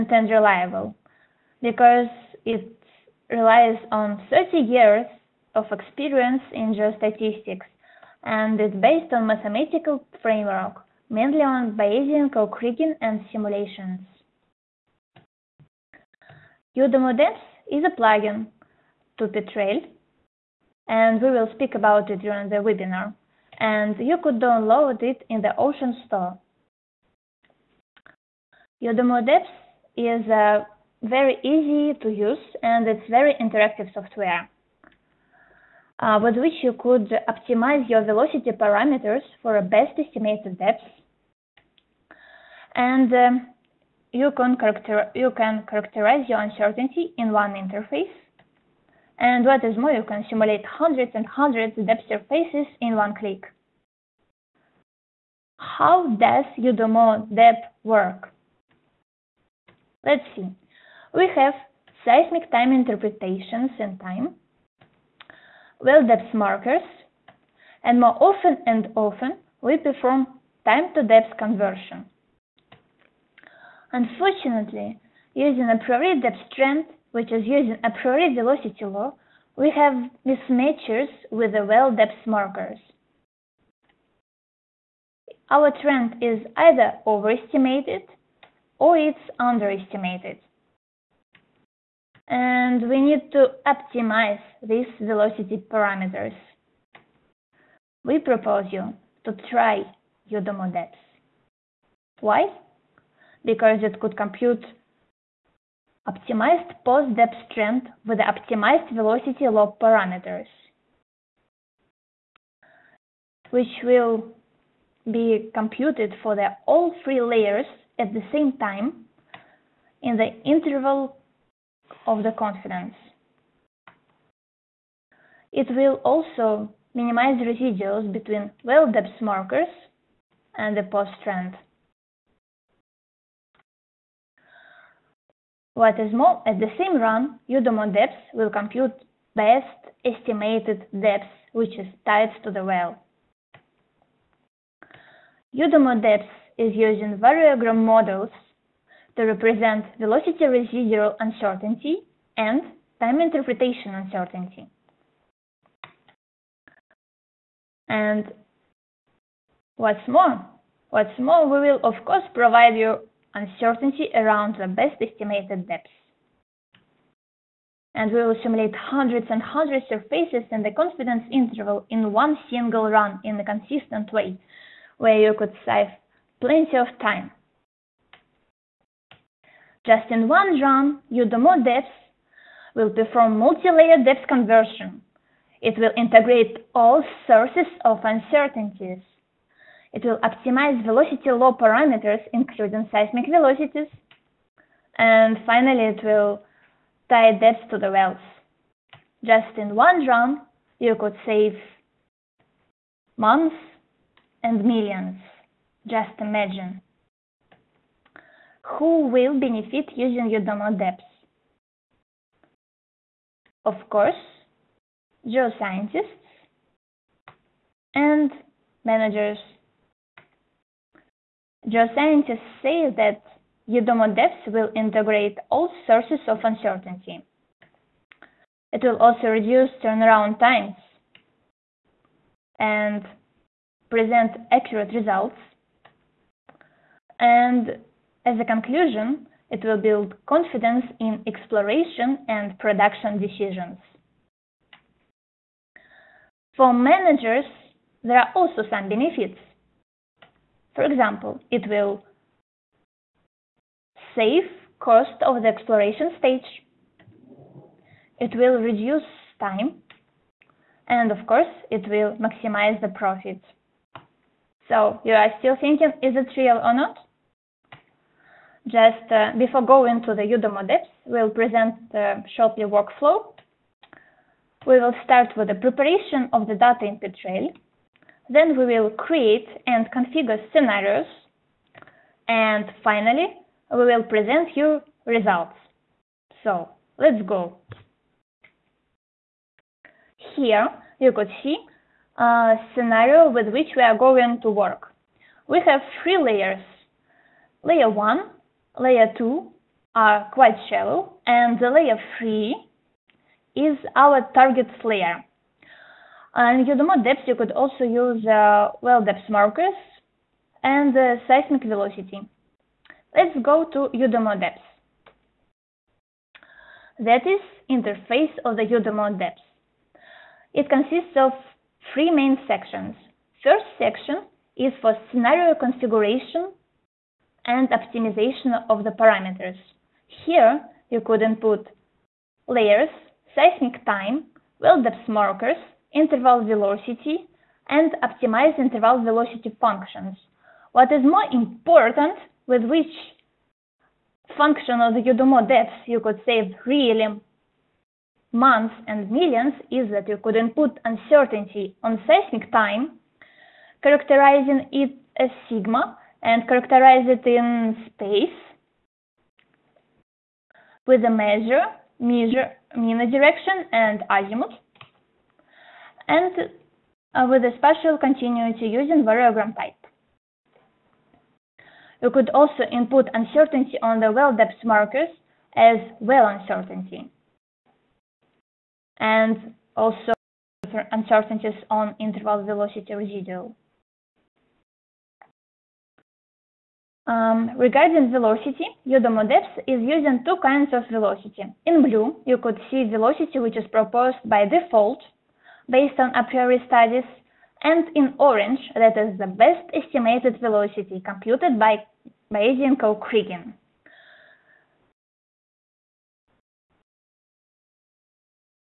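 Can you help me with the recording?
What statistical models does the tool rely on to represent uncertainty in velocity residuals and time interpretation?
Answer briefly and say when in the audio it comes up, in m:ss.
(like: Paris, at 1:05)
Variogram models, at 2:27.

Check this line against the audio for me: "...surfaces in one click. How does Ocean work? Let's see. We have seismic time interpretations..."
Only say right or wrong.
wrong.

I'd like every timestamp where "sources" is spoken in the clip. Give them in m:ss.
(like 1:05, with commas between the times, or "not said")
3:07, 3:45.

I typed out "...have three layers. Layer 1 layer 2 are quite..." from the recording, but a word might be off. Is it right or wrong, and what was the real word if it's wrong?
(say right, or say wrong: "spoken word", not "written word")
right.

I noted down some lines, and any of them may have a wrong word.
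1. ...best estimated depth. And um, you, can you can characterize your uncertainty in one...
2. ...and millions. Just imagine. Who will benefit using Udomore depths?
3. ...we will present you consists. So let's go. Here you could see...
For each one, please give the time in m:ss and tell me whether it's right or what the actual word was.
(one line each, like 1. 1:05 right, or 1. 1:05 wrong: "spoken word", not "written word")
1. 0:39 right
2. 3:24 right
3. 4:43 wrong: "results", not "consists".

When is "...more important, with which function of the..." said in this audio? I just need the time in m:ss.
5:41.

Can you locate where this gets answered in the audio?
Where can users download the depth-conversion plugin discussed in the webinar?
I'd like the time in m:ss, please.
0:25.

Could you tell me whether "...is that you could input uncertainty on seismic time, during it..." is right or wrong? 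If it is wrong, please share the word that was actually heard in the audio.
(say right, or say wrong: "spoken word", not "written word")
wrong: "characterizing", not "during".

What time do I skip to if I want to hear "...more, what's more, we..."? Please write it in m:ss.
2:40.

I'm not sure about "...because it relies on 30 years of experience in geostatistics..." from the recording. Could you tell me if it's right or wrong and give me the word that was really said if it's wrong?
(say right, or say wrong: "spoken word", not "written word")
right.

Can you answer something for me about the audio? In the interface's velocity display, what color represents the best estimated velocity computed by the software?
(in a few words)
Orange.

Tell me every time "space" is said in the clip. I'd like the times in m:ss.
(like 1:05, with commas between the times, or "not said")
5:57.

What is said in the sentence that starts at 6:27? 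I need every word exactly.
Um, regarding velocity, Udomore Depths is using two kinds of velocity.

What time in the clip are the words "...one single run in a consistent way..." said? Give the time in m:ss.
2:52.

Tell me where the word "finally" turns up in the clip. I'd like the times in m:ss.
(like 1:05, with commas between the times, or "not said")
3:15, 4:42.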